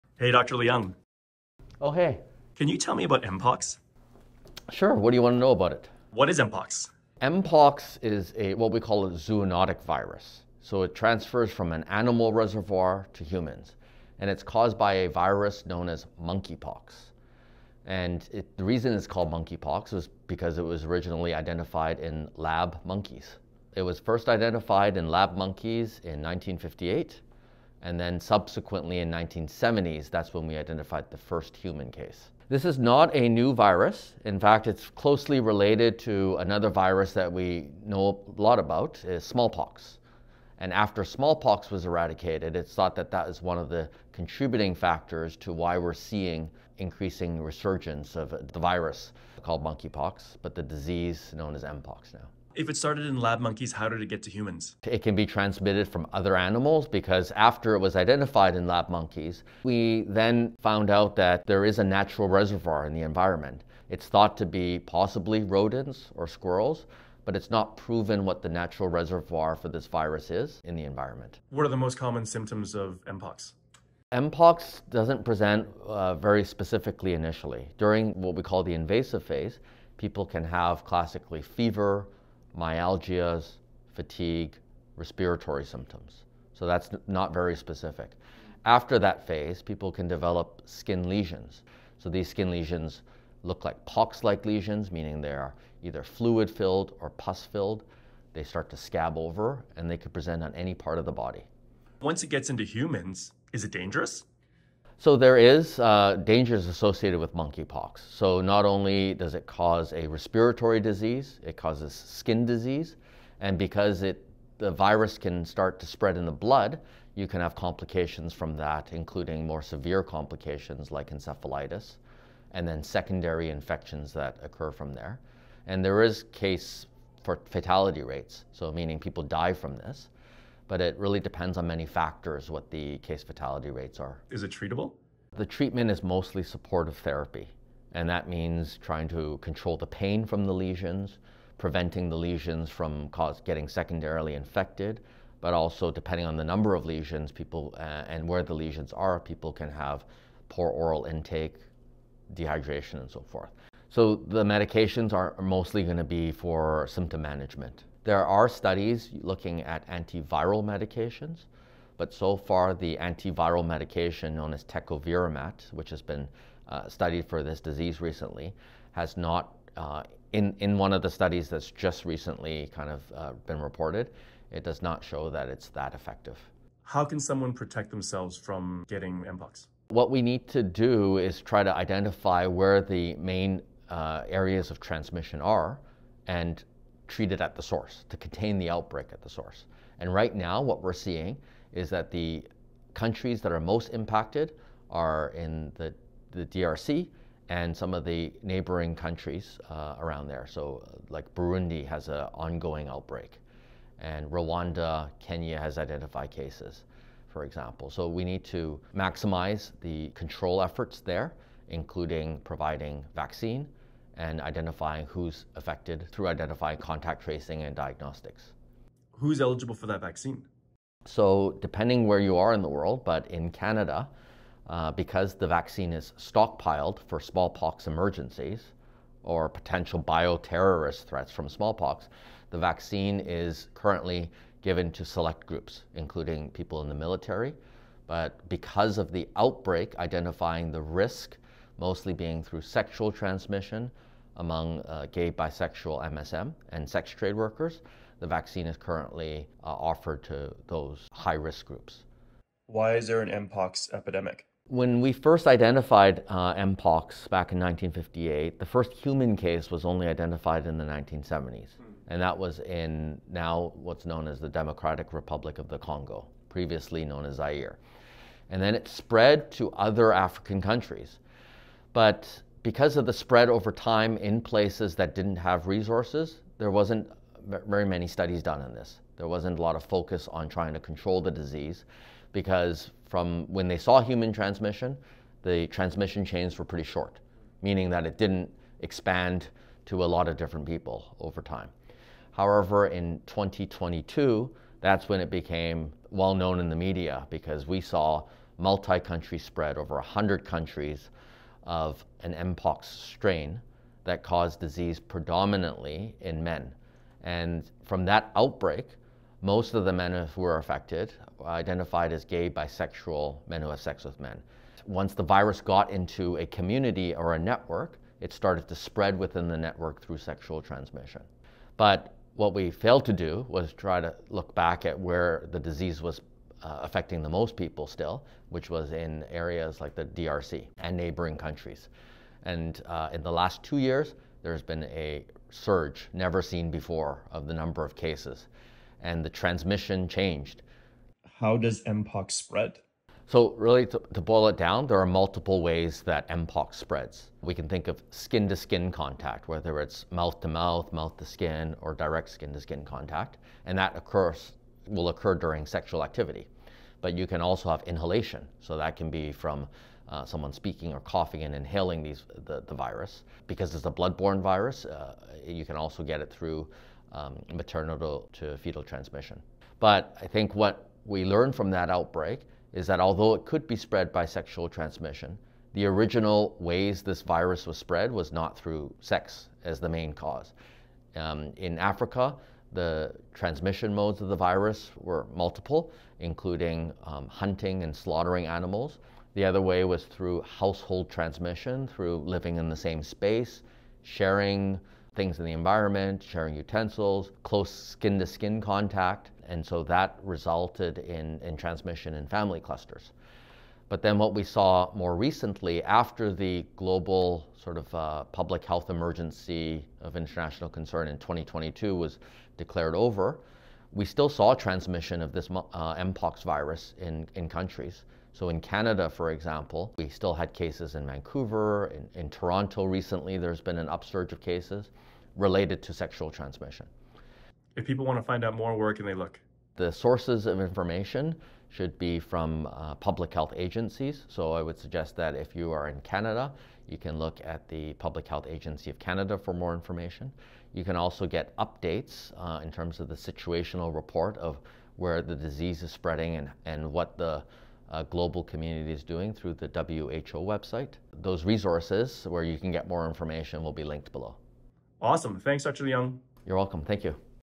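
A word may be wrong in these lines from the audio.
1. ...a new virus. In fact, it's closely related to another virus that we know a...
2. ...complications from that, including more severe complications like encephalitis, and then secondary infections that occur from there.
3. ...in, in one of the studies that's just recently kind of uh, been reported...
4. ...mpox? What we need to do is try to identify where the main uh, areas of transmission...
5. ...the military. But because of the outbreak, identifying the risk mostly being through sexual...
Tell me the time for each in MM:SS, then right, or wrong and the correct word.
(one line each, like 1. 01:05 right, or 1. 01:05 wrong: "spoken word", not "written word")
1. 00:33 right
2. 01:57 right
3. 02:50 right
4. 02:59 right
5. 03:56 right.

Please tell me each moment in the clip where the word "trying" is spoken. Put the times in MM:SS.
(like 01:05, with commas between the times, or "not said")
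02:18, 04:40.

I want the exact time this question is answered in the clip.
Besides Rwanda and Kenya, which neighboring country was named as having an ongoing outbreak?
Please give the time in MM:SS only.
03:21.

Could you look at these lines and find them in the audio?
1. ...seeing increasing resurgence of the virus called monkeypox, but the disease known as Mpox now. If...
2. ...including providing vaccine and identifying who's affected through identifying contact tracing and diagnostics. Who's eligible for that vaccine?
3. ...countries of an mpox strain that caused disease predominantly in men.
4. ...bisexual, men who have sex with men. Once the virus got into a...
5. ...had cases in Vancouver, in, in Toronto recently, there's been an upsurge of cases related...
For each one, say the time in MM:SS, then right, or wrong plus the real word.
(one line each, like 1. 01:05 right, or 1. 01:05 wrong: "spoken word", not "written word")
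1. 00:45 right
2. 03:31 right
3. 05:00 right
4. 05:12 right
5. 07:00 right.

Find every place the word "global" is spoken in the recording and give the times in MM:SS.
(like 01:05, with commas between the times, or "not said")
06:46, 07:28.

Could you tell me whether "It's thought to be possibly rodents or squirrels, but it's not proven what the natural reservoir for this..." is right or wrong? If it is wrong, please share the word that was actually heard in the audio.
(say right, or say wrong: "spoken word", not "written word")
right.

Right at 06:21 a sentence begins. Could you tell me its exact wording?
Um, in Africa, the transmission modes of the virus were multiple, including um, hunting and slaughtering animals.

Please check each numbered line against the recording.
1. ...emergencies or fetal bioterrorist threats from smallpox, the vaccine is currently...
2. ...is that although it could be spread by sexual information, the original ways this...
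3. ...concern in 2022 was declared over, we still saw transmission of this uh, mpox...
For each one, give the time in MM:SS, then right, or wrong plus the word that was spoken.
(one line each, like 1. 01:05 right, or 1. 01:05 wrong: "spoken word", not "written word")
1. 03:47 wrong: "potential", not "fetal"
2. 06:12 wrong: "transmission", not "information"
3. 06:50 right.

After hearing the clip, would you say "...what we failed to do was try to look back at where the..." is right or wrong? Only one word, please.
right.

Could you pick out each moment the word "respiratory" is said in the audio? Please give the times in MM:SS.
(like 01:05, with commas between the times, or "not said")
01:24, 01:50.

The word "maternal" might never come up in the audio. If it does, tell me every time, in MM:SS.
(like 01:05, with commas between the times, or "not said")
06:07.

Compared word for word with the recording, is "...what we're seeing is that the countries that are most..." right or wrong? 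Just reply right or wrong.
right.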